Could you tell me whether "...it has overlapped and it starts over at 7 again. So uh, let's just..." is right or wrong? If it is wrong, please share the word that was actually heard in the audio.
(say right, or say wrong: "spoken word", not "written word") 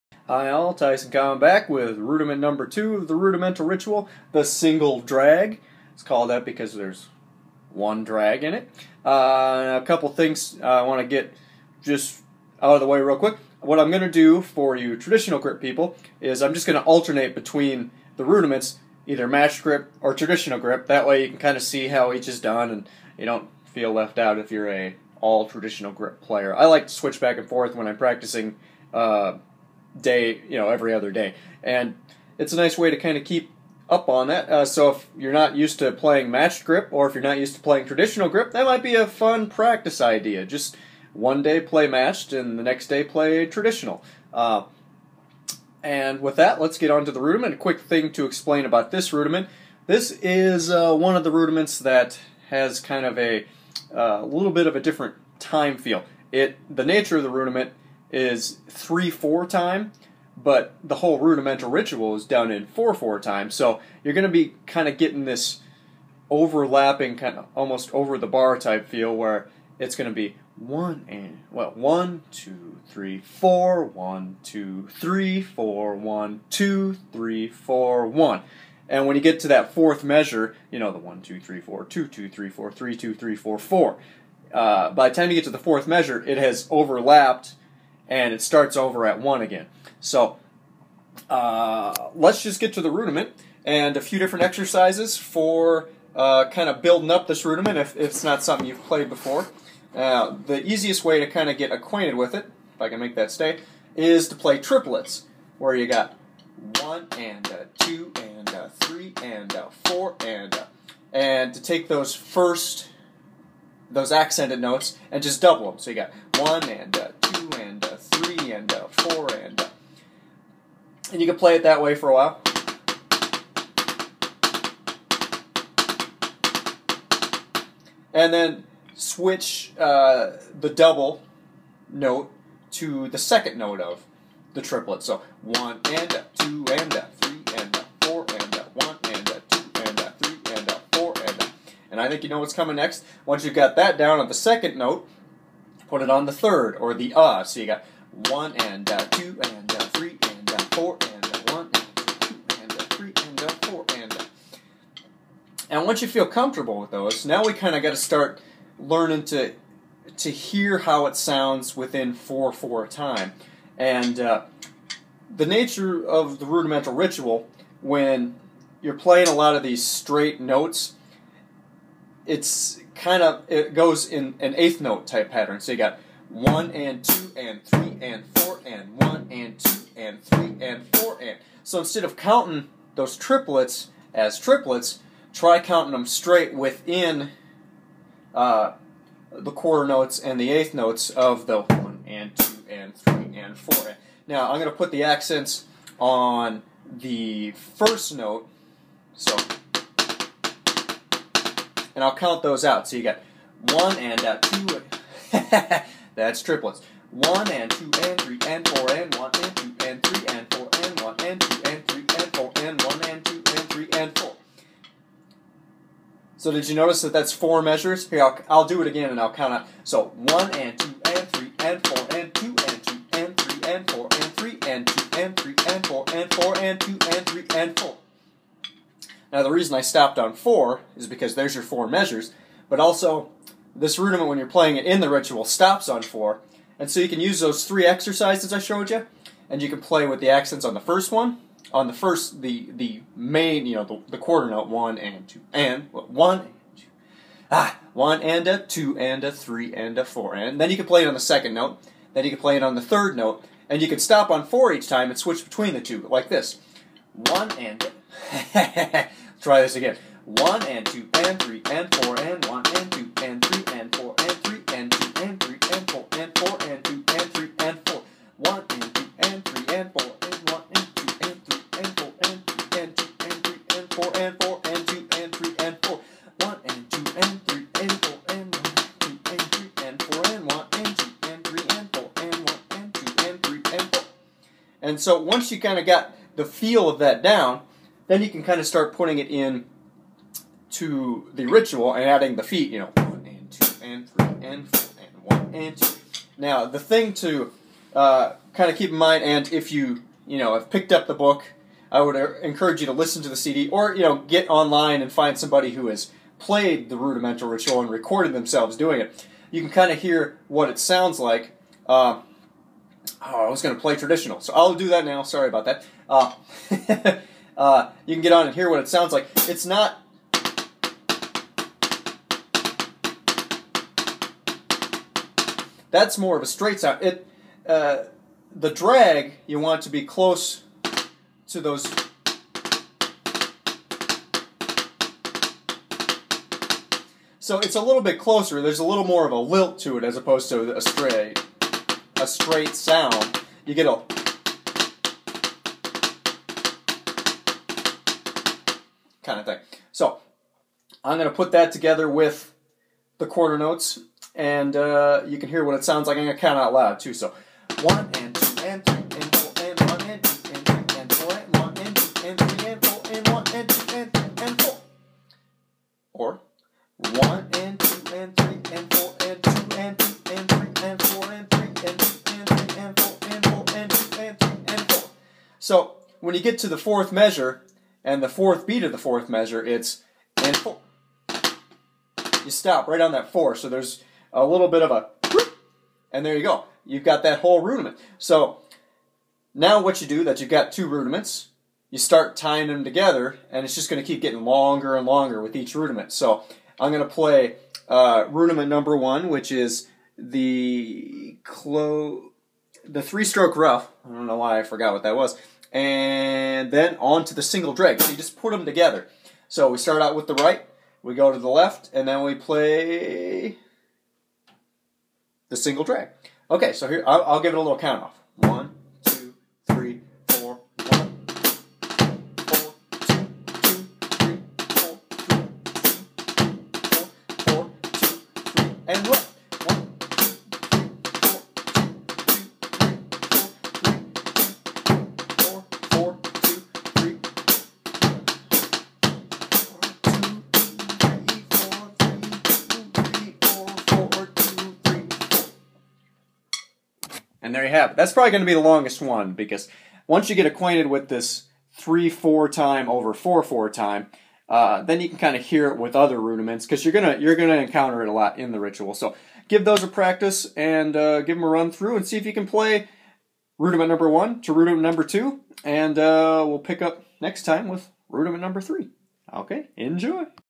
wrong: "1", not "7".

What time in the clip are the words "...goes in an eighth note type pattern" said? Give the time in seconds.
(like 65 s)
173 s.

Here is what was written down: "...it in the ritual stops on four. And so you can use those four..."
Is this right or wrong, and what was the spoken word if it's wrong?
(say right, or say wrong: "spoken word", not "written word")
wrong: "three", not "four".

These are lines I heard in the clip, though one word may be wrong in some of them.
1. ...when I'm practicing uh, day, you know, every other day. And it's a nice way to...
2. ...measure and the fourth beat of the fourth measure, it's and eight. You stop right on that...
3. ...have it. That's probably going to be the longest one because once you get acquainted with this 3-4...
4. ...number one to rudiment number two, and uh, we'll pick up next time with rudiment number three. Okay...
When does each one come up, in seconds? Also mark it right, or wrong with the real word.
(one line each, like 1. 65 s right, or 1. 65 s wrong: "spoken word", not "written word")
1. 27 s right
2. 377 s wrong: "four", not "eight"
3. 447 s right
4. 463 s right.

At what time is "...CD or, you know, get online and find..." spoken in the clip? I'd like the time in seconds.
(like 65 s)
303 s.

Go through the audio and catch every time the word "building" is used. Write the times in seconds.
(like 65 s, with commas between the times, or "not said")
96 s.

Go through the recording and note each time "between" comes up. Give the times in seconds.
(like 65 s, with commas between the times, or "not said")
17 s, 255 s.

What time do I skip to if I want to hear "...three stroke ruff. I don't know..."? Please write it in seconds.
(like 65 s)
403 s.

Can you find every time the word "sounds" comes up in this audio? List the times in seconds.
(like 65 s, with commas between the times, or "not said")
161 s, 310 s, 318 s, 326 s, 342 s, 355 s.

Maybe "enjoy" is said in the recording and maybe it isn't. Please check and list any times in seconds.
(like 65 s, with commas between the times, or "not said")
469 s.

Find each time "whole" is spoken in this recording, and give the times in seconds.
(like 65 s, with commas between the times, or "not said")
60 s, 387 s.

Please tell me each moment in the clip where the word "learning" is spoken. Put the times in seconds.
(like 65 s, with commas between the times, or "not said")
158 s.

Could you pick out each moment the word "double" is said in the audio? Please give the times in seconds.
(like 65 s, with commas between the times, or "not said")
115 s, 130 s.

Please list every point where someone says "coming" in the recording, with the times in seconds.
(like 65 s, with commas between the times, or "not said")
1 s, 142 s.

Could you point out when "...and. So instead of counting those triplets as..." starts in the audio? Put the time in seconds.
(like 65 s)
181 s.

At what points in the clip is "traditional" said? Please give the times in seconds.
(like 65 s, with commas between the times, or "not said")
14 s, 20 s, 25 s, 37 s, 43 s, 313 s.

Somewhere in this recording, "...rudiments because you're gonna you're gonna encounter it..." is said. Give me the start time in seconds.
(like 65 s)
456 s.